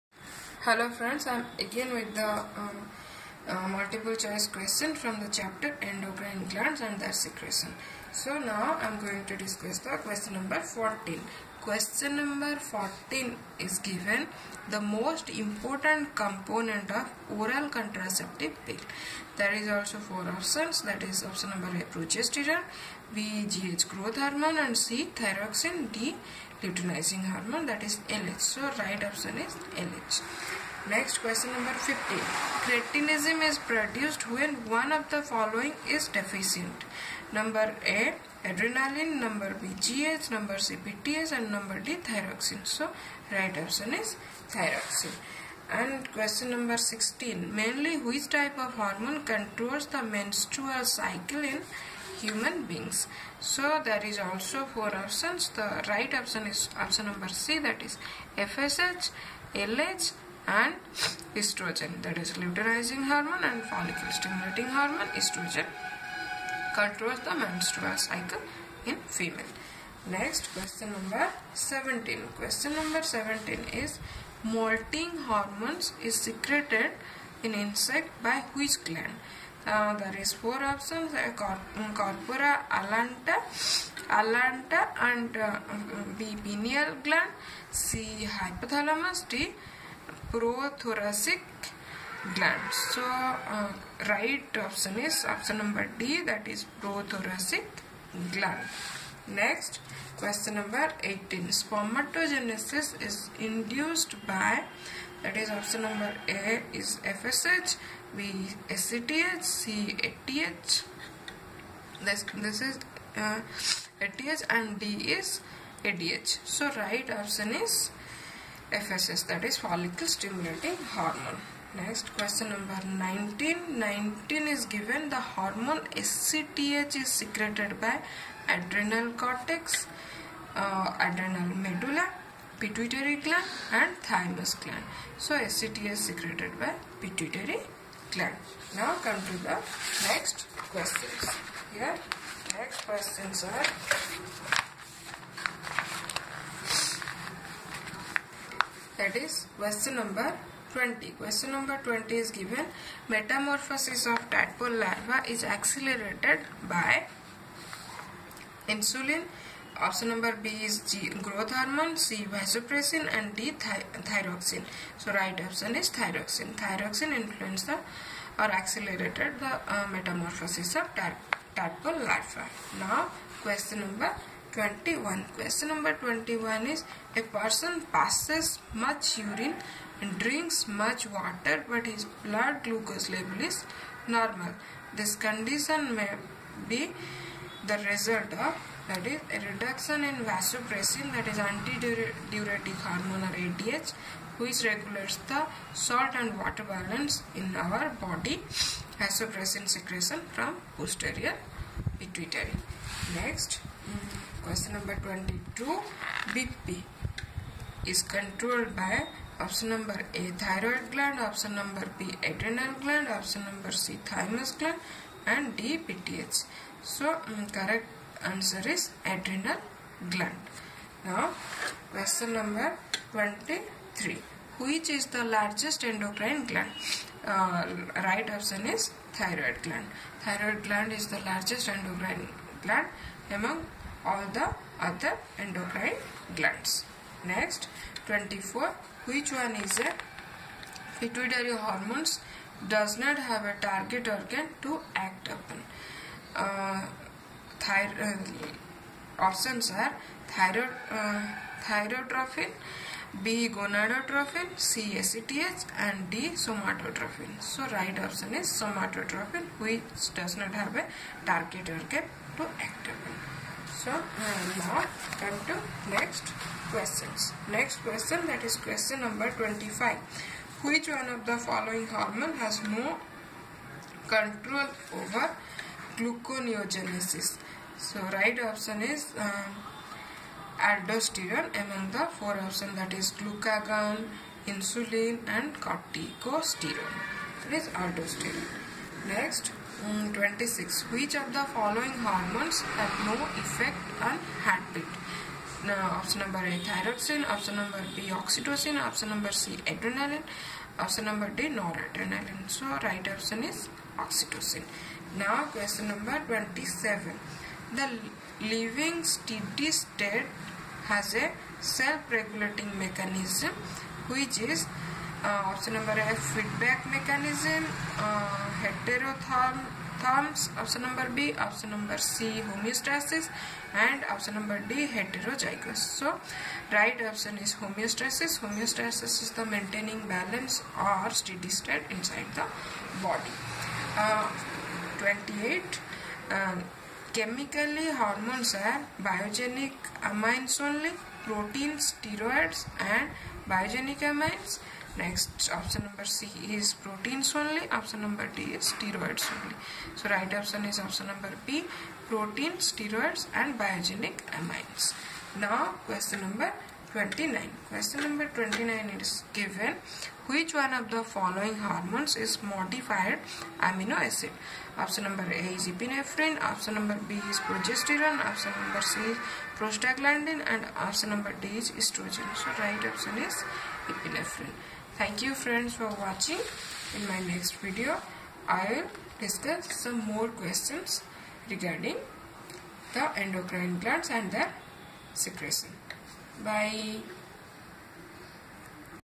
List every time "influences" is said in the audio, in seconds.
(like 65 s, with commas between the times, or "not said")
167 s.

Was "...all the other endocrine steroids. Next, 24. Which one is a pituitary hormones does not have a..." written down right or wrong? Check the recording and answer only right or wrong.
wrong.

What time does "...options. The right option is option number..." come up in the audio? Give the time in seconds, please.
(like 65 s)
54 s.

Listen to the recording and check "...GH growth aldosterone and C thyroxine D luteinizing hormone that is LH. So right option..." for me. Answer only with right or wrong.
wrong.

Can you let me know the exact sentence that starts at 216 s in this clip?
So um, correct answer is adrenal gland.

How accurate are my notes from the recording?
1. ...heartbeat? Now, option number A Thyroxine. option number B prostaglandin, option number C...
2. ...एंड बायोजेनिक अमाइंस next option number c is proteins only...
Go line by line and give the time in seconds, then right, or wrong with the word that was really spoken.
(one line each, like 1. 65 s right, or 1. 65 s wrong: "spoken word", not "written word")
1. 294 s wrong: "oxytocin", not "prostaglandin"
2. 342 s right.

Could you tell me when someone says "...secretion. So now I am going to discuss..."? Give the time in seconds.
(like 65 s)
7 s.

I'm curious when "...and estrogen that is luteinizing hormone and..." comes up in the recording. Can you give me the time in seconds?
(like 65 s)
60 s.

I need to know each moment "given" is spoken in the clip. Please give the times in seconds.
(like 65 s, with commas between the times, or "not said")
13 s, 124 s, 152 s, 359 s.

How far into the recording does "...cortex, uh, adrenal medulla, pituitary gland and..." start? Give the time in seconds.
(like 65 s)
129 s.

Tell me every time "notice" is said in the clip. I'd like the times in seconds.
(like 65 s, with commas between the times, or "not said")
not said.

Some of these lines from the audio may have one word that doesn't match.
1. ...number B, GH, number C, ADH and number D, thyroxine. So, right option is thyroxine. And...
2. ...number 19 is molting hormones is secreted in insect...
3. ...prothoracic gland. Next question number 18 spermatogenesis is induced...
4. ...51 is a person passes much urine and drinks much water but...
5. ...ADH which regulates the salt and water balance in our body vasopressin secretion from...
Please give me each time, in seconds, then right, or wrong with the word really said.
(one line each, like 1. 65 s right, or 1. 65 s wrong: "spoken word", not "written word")
1. 39 s wrong: "PTH", not "ADH"
2. 72 s wrong: "17", not "19"
3. 96 s right
4. 175 s wrong: "21", not "51"
5. 193 s right.